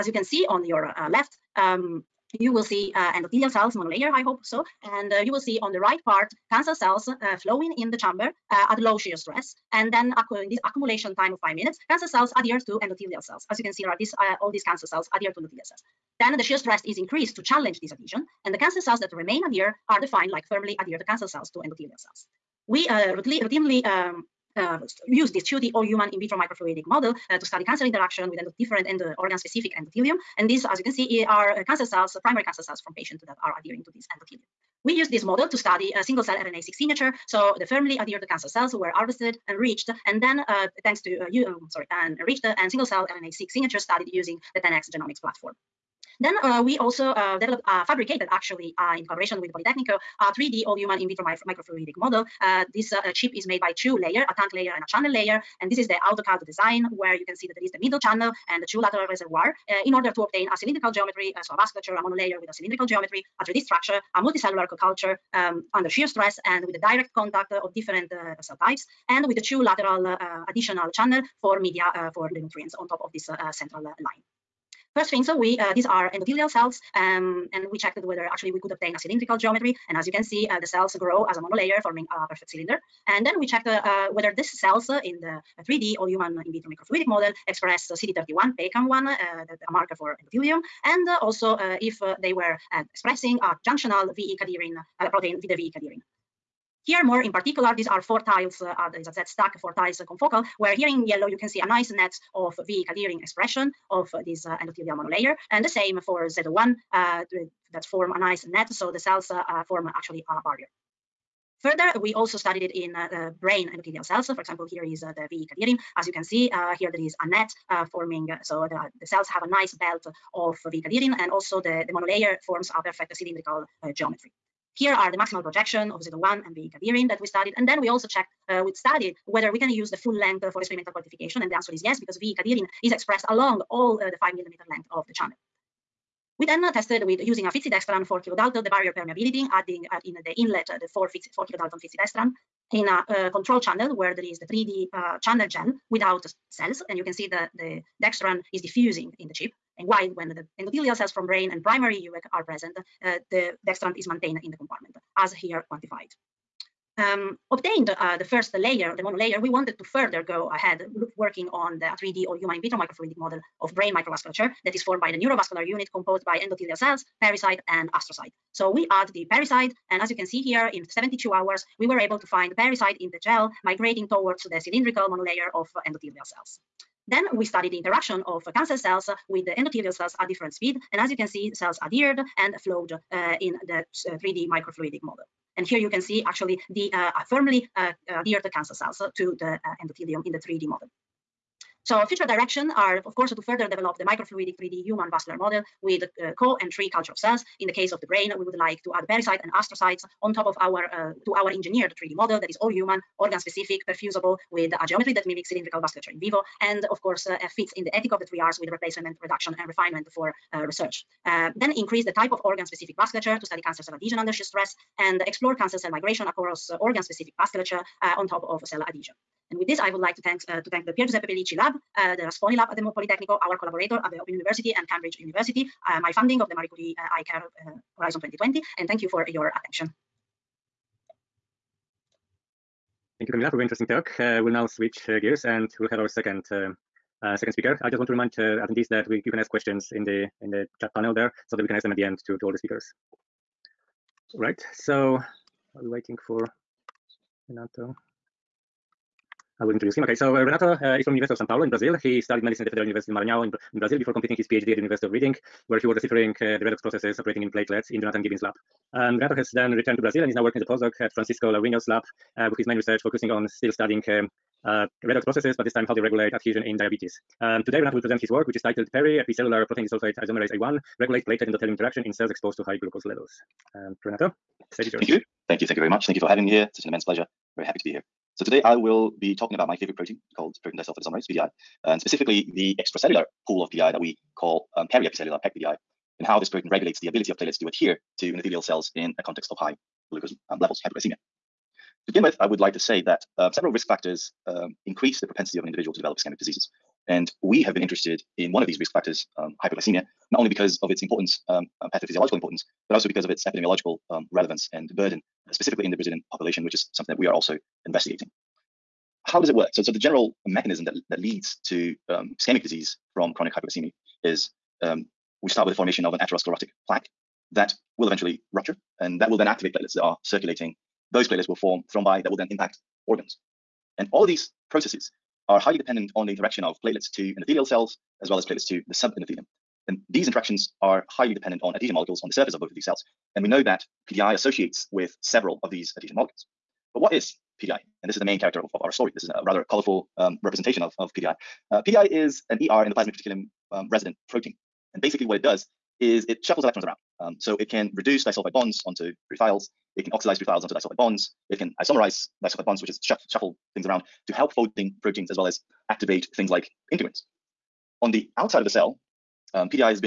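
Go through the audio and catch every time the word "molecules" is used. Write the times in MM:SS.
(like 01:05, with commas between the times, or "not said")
05:31, 05:36.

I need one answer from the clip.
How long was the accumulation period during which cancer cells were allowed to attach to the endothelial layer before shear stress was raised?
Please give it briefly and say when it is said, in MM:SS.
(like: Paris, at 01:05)
5 minutes, at 00:11.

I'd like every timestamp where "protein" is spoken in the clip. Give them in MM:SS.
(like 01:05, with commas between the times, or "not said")
01:35, 04:29, 04:39, 04:46, 05:44, 05:55.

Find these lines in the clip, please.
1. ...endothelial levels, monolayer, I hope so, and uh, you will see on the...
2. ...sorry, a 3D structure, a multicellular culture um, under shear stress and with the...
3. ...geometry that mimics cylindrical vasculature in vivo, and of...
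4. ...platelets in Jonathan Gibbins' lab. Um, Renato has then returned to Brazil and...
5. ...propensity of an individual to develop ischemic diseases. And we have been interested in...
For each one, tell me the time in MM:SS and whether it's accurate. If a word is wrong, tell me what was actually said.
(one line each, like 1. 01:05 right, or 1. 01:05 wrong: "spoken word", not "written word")
1. 00:03 wrong: "cells", not "levels"
2. 01:02 wrong: "geometry", not "sorry"
3. 03:24 right
4. 04:17 right
5. 04:55 right.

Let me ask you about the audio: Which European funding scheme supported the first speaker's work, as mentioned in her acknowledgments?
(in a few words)
Marie Curie.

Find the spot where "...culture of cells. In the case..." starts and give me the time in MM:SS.
03:16.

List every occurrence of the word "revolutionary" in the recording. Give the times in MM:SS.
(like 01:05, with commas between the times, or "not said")
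not said.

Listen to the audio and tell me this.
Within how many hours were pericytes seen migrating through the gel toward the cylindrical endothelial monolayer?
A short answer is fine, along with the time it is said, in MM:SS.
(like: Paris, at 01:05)
72 hours, at 02:50.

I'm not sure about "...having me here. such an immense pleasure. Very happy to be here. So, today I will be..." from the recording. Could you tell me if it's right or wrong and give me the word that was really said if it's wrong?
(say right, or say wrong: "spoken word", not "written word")
right.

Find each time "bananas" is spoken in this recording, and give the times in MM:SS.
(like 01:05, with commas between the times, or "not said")
not said.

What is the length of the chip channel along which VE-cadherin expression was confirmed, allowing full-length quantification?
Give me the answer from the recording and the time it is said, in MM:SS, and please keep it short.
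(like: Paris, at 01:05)
5 millimeters, at 02:14.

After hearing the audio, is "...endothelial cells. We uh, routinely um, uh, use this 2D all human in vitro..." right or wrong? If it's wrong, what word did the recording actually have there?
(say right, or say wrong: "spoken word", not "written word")
right.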